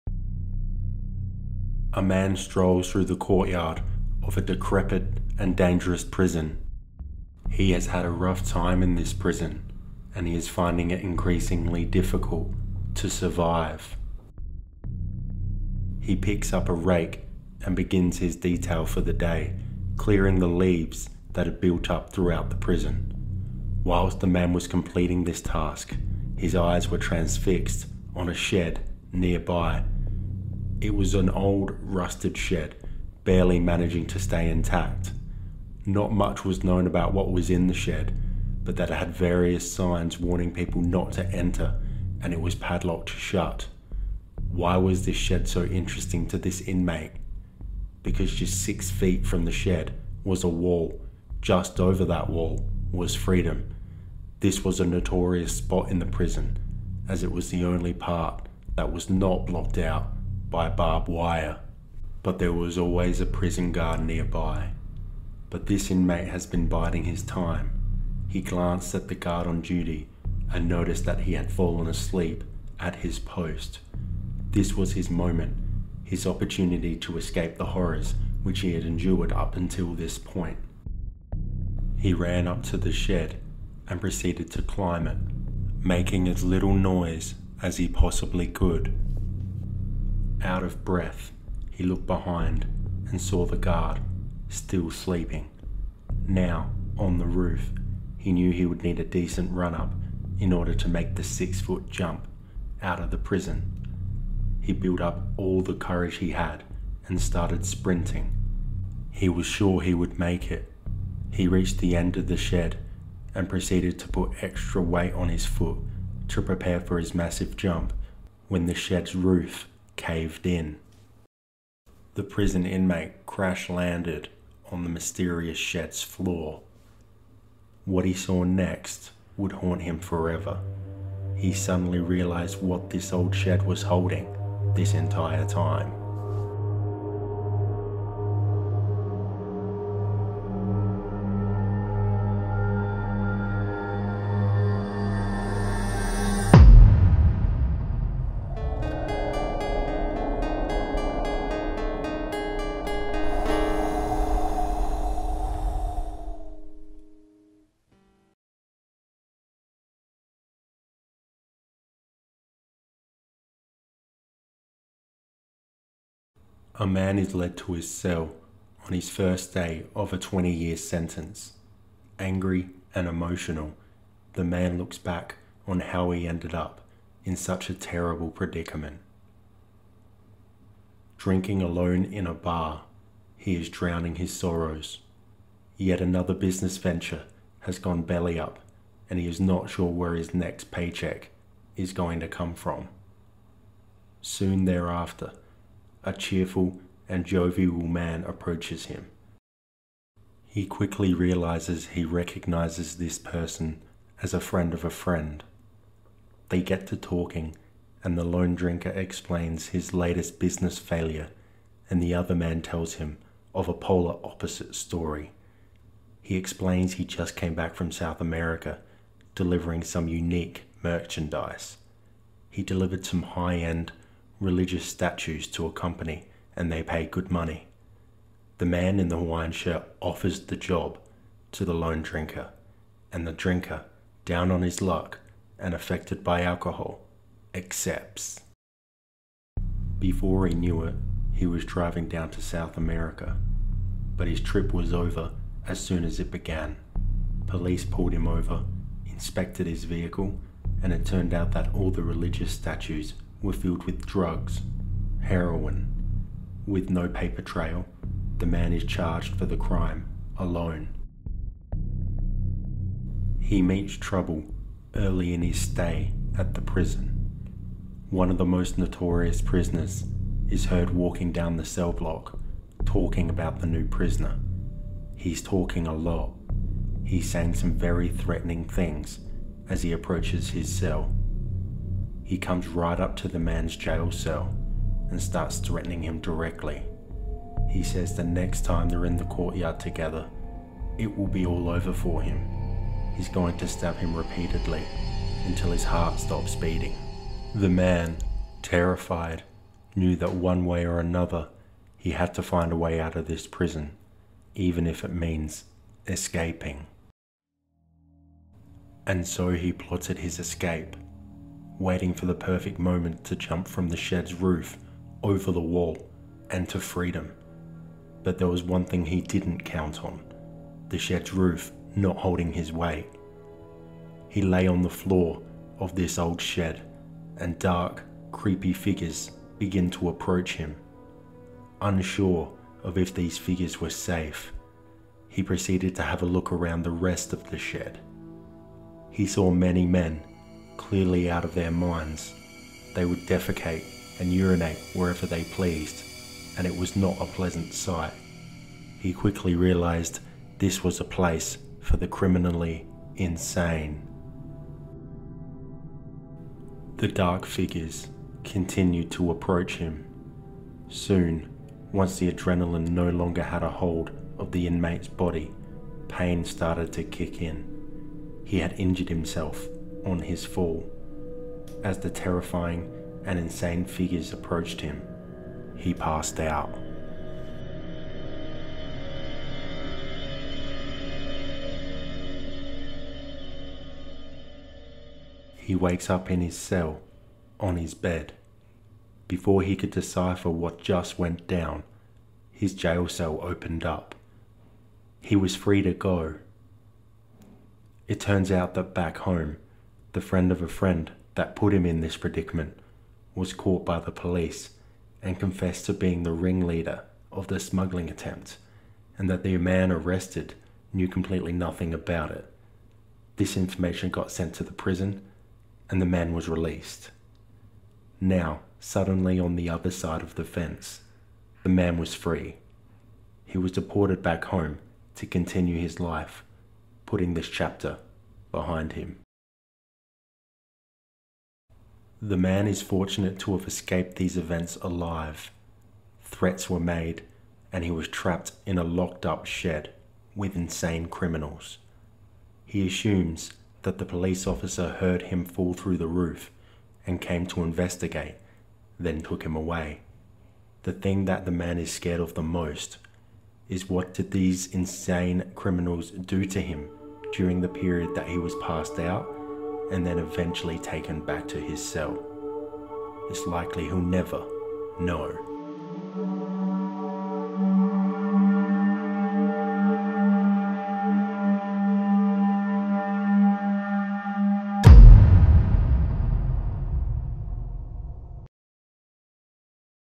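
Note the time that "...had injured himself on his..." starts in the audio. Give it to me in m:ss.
6:08.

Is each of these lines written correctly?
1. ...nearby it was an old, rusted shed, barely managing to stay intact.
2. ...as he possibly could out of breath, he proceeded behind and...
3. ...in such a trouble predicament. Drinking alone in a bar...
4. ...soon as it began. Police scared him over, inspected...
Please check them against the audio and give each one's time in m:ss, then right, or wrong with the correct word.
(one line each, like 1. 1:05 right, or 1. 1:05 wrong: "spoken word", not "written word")
1. 0:29 right
2. 1:27 wrong: "looked", not "proceeded"
3. 2:57 wrong: "terrible", not "trouble"
4. 4:05 wrong: "pulled", not "scared".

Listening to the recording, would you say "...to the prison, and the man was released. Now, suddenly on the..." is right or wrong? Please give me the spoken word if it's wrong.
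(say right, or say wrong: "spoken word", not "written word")
right.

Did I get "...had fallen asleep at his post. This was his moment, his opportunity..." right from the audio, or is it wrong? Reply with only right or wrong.
right.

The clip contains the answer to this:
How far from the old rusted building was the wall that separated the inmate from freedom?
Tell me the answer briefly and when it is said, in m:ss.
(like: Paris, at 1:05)
six feet, at 0:48.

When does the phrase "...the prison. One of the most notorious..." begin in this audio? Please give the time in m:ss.
4:26.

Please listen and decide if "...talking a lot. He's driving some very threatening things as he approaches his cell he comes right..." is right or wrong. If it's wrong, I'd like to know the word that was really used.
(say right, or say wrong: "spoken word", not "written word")
wrong: "saying", not "driving".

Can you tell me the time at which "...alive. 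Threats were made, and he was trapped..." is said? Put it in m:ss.
7:14.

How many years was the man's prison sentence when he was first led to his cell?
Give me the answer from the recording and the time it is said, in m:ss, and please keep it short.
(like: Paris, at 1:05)
20, at 2:50.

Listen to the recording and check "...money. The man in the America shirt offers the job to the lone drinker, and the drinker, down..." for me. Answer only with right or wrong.
wrong.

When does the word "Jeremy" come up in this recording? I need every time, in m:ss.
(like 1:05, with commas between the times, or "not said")
not said.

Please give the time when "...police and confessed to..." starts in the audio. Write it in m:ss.
6:44.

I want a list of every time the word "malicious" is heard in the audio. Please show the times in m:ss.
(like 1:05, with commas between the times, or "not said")
not said.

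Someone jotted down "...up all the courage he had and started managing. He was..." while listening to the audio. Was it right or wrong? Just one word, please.
wrong.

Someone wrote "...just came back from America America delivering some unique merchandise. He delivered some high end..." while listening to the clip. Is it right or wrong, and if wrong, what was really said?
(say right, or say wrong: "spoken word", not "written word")
wrong: "South", not "America".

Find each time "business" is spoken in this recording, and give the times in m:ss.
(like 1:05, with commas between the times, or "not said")
3:06, 3:30.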